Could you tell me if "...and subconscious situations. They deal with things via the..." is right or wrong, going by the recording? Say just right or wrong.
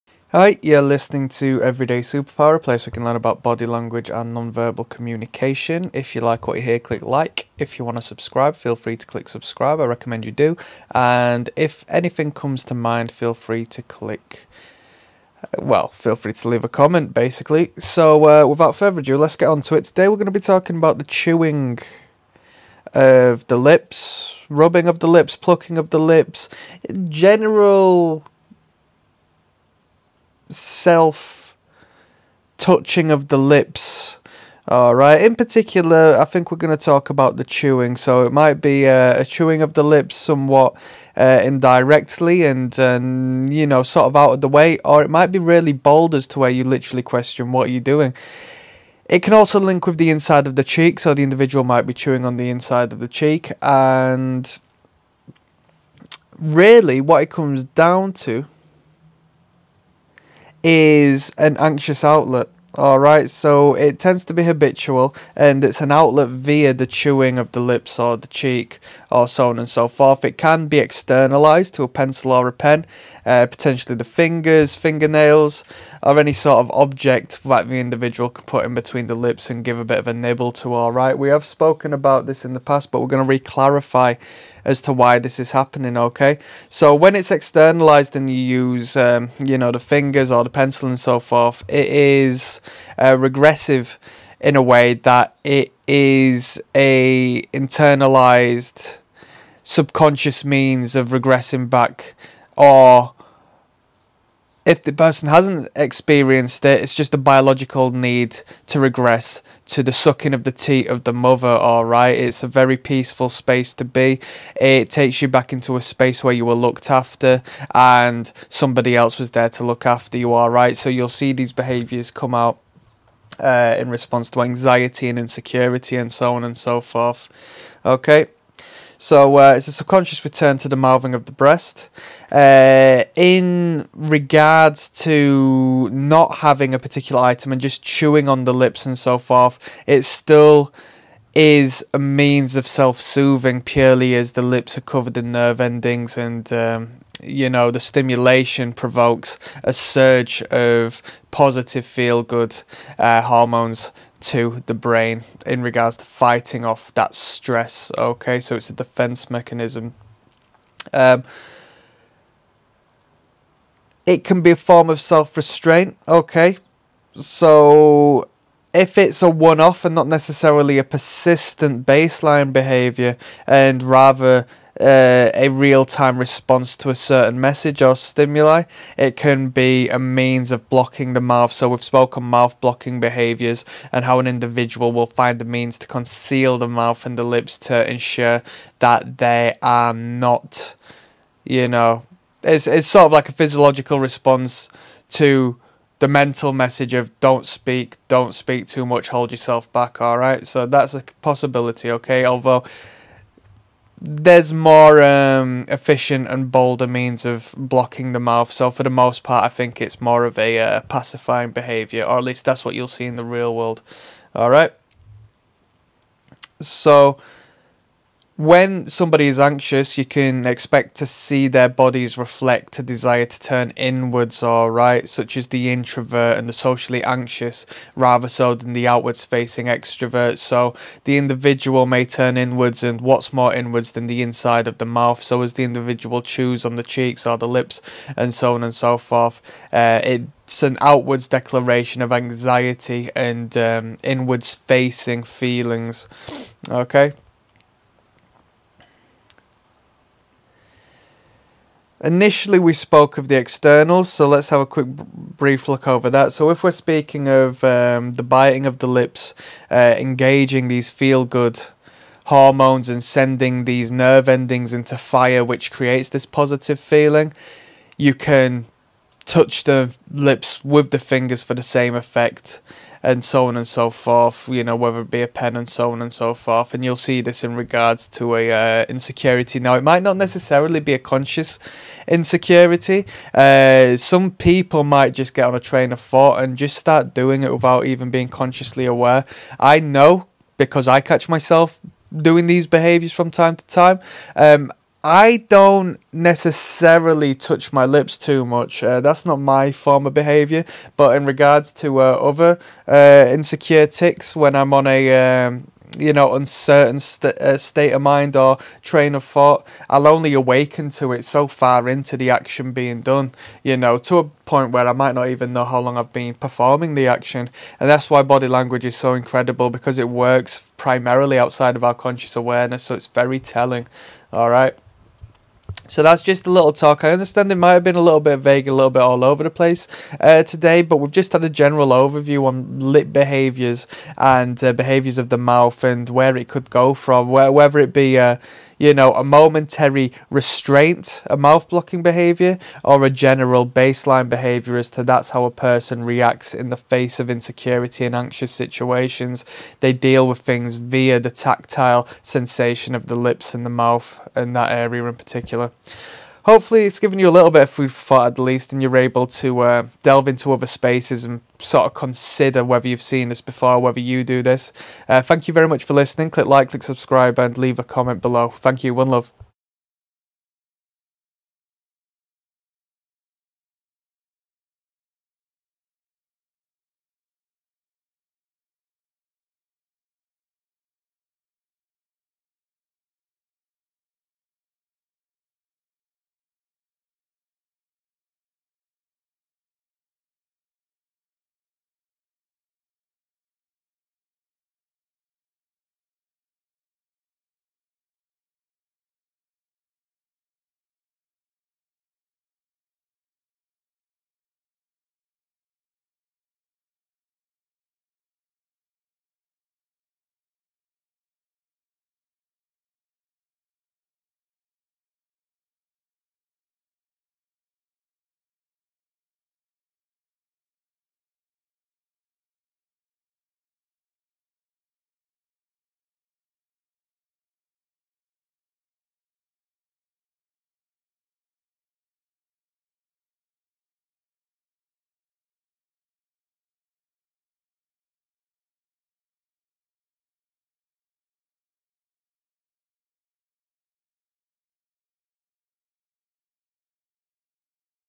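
wrong.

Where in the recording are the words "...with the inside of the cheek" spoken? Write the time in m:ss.
0:49.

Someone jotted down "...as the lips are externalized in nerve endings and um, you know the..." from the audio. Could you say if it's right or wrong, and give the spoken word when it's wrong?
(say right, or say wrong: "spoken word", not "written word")
wrong: "covered", not "externalized".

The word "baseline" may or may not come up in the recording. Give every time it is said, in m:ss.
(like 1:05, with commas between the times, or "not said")
2:51, 5:43.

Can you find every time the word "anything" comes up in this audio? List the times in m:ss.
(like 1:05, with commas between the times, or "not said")
0:11.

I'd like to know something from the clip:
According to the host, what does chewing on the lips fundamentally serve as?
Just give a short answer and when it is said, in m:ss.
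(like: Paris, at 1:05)
An anxious outlet, at 1:01.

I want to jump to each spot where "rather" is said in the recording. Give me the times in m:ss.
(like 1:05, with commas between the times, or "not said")
2:53, 3:47.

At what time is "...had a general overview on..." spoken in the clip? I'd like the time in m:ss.
5:31.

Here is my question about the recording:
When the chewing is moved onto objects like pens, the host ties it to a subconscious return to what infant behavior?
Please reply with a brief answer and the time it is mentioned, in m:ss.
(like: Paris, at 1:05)
Sucking of the teat, at 1:49.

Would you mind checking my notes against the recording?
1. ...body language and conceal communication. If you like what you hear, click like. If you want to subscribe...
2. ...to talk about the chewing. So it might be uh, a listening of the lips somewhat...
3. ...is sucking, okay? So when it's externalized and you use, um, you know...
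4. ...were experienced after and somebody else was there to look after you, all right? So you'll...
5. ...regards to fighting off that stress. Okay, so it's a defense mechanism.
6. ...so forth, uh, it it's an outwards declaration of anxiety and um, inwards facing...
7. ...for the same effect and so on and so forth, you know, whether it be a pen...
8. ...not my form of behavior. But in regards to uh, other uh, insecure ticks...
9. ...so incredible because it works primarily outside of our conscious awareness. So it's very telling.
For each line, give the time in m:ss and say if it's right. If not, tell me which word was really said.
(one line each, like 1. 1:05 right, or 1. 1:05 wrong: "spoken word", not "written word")
1. 0:03 wrong: "nonverbal", not "conceal"
2. 0:36 wrong: "chewing", not "listening"
3. 1:25 wrong: "happening", not "sucking"
4. 1:56 wrong: "looked", not "experienced"
5. 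2:35 right
6. 3:58 right
7. 4:31 right
8. 4:59 right
9. 5:18 right.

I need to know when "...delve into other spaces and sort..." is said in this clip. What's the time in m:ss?
6:00.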